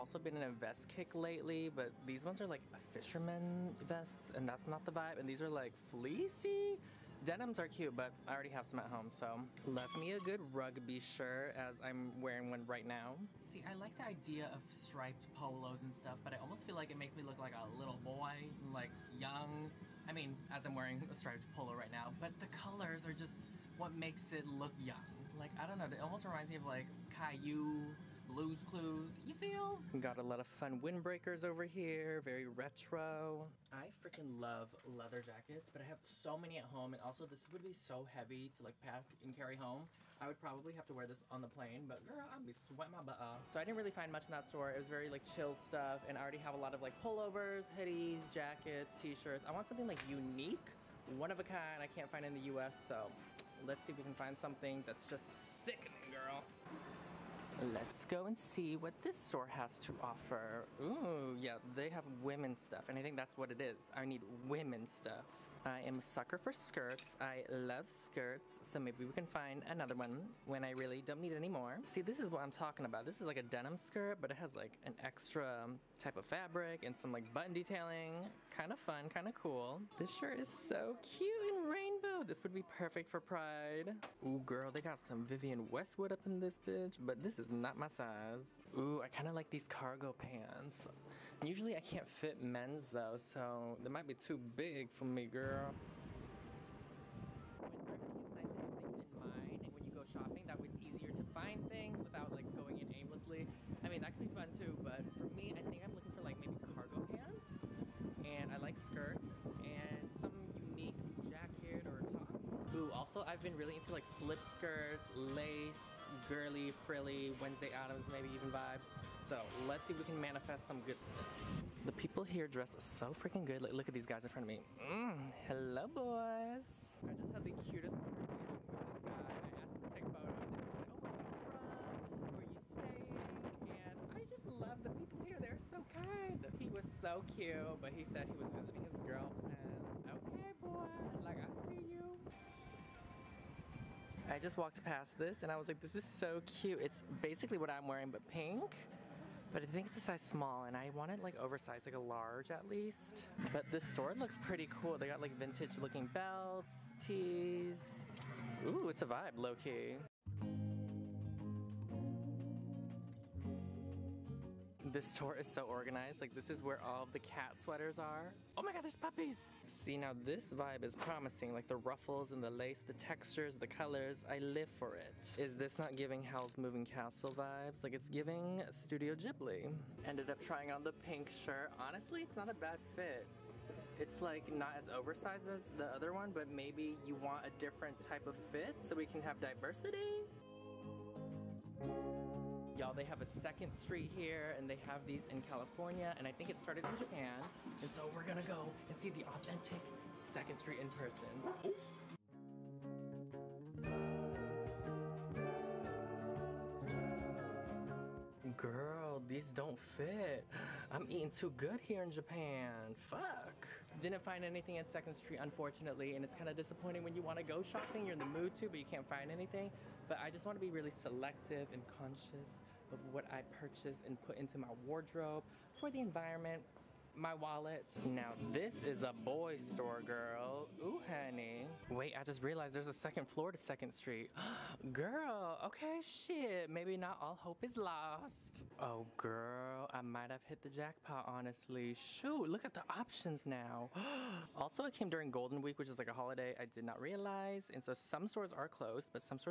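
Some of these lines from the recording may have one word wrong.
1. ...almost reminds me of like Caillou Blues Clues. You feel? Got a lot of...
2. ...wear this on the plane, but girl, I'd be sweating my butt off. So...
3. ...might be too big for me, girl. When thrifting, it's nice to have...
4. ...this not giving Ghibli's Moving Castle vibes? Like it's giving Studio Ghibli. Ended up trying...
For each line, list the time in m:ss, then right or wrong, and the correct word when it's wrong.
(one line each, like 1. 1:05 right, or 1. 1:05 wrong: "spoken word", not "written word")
1. 0:25 right
2. 0:40 right
3. 1:33 right
4. 2:55 wrong: "Howl", not "Ghibli".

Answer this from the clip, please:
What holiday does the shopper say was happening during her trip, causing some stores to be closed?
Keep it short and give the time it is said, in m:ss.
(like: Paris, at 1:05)
Golden Week, at 4:05.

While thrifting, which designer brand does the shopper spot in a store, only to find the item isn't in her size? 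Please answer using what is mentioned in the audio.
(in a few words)
Vivienne Westwood.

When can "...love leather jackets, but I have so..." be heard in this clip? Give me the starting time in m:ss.
0:34.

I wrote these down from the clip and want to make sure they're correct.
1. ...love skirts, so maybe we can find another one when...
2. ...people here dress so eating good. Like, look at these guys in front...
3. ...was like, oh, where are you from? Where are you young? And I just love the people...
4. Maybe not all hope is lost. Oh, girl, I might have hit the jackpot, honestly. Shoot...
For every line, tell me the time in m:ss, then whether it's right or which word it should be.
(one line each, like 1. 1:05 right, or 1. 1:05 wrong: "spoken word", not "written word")
1. 1:07 right
2. 2:01 wrong: "freaking", not "eating"
3. 2:10 wrong: "staying", not "young"
4. 3:56 right.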